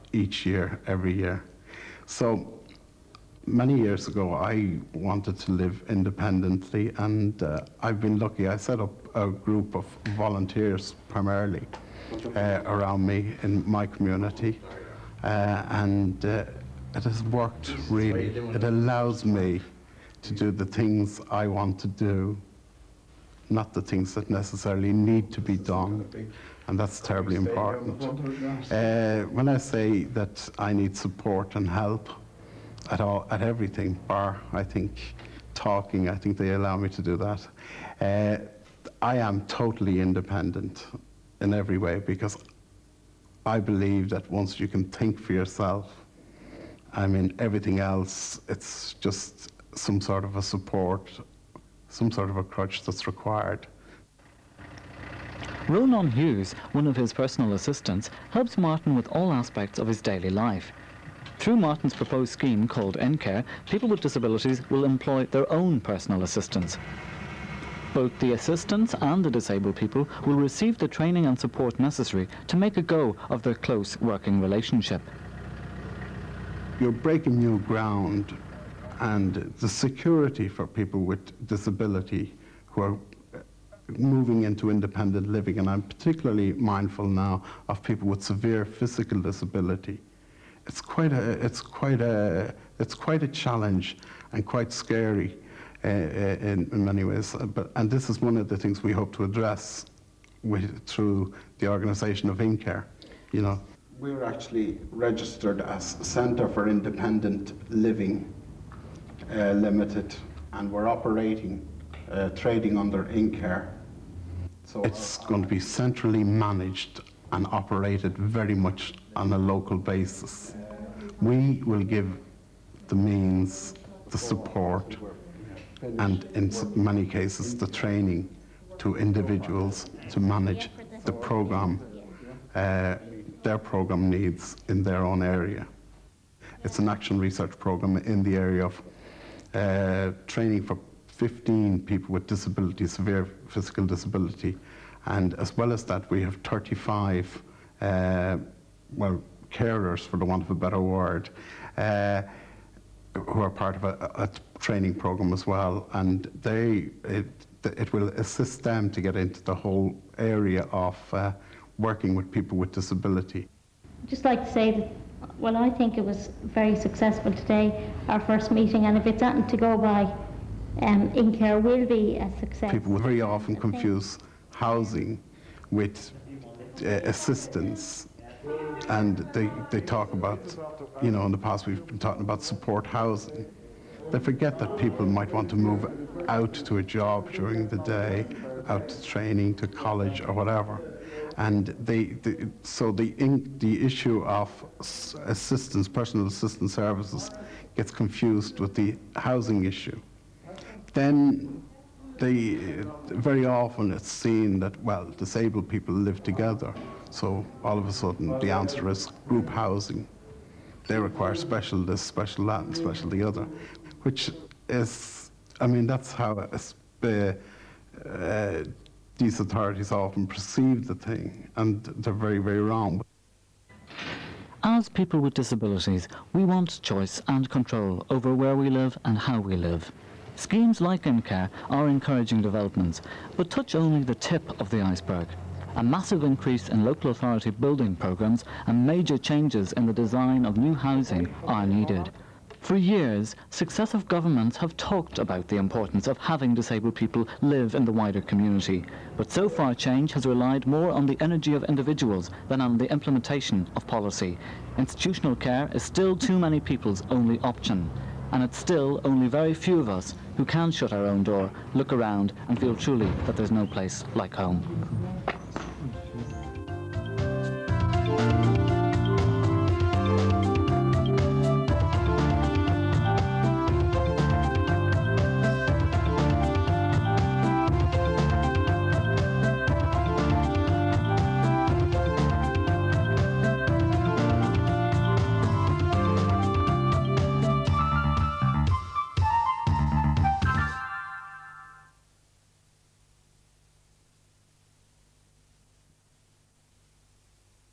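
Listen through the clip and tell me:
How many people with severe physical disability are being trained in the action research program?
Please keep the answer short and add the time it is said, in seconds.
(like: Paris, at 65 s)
15, at 141 s.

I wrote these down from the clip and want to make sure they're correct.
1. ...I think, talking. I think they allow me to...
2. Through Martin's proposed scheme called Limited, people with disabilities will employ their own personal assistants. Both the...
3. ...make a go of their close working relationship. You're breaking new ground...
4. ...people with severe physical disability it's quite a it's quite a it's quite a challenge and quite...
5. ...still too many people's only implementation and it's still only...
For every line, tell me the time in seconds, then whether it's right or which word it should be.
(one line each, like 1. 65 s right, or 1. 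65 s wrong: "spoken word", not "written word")
1. 34 s right
2. 61 s wrong: "InCare", not "Limited"
3. 72 s right
4. 87 s right
5. 255 s wrong: "option", not "implementation".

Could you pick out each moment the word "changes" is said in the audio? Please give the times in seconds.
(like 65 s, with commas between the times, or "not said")
239 s, 249 s.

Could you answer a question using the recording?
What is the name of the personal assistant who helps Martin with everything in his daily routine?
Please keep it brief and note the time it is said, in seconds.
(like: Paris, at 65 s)
Ronan Hughes, at 55 s.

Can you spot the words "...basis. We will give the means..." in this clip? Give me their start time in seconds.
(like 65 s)
119 s.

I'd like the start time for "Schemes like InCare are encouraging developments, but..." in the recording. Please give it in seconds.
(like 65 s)
230 s.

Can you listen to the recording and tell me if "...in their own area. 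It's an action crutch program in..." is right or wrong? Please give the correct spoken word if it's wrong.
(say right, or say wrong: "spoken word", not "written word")
wrong: "research", not "crutch".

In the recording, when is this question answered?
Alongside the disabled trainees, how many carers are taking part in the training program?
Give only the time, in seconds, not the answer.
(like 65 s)
146 s.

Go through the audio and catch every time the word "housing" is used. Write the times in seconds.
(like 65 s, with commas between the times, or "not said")
174 s, 182 s, 199 s, 209 s, 240 s.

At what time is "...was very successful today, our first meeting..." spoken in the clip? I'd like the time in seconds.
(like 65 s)
166 s.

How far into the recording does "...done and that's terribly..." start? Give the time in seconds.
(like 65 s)
25 s.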